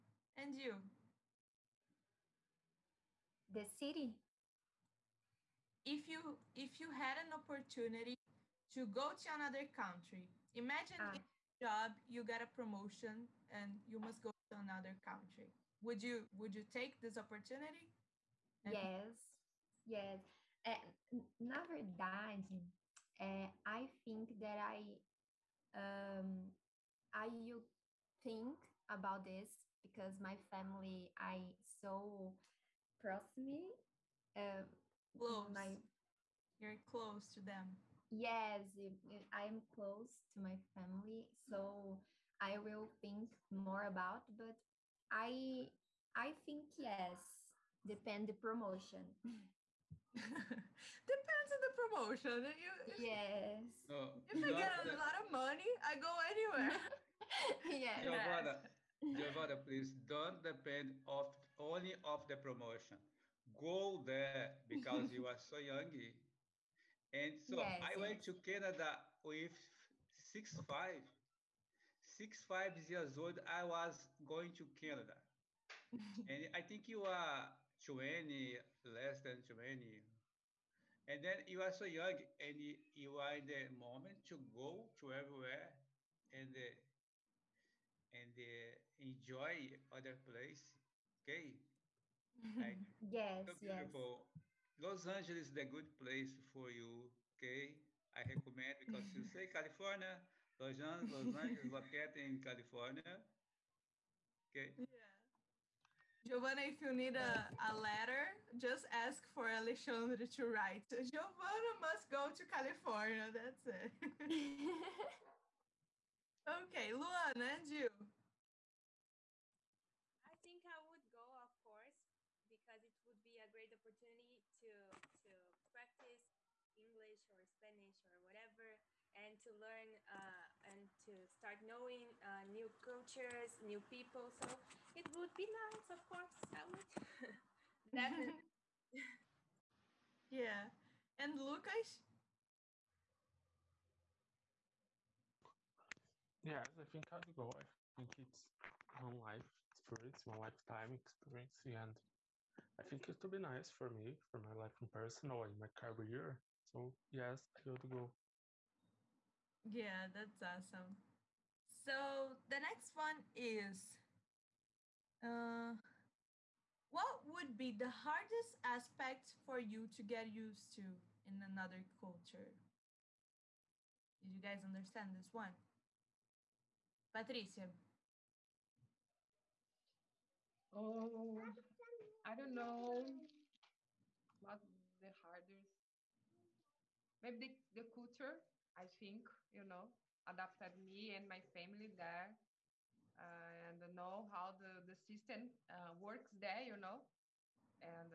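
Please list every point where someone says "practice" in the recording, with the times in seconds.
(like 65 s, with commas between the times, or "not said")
125 s.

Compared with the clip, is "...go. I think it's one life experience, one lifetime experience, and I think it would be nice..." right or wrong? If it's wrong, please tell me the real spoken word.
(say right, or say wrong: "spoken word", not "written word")
right.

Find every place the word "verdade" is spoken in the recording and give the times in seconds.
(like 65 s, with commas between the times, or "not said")
21 s.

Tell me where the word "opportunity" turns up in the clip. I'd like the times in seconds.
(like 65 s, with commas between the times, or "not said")
7 s, 17 s, 123 s.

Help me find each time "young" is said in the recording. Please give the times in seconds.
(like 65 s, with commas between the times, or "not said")
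65 s, 81 s.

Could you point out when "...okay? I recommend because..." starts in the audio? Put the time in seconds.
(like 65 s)
97 s.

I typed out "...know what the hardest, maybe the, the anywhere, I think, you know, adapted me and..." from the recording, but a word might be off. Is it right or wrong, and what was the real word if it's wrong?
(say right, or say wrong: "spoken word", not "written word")
wrong: "culture", not "anywhere".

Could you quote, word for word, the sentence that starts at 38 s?
Yes, I'm close to my family, so I will think more about.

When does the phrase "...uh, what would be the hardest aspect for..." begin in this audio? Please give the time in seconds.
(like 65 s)
165 s.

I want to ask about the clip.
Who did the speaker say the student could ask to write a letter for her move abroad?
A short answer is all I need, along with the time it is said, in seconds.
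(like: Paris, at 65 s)
Alexandre, at 109 s.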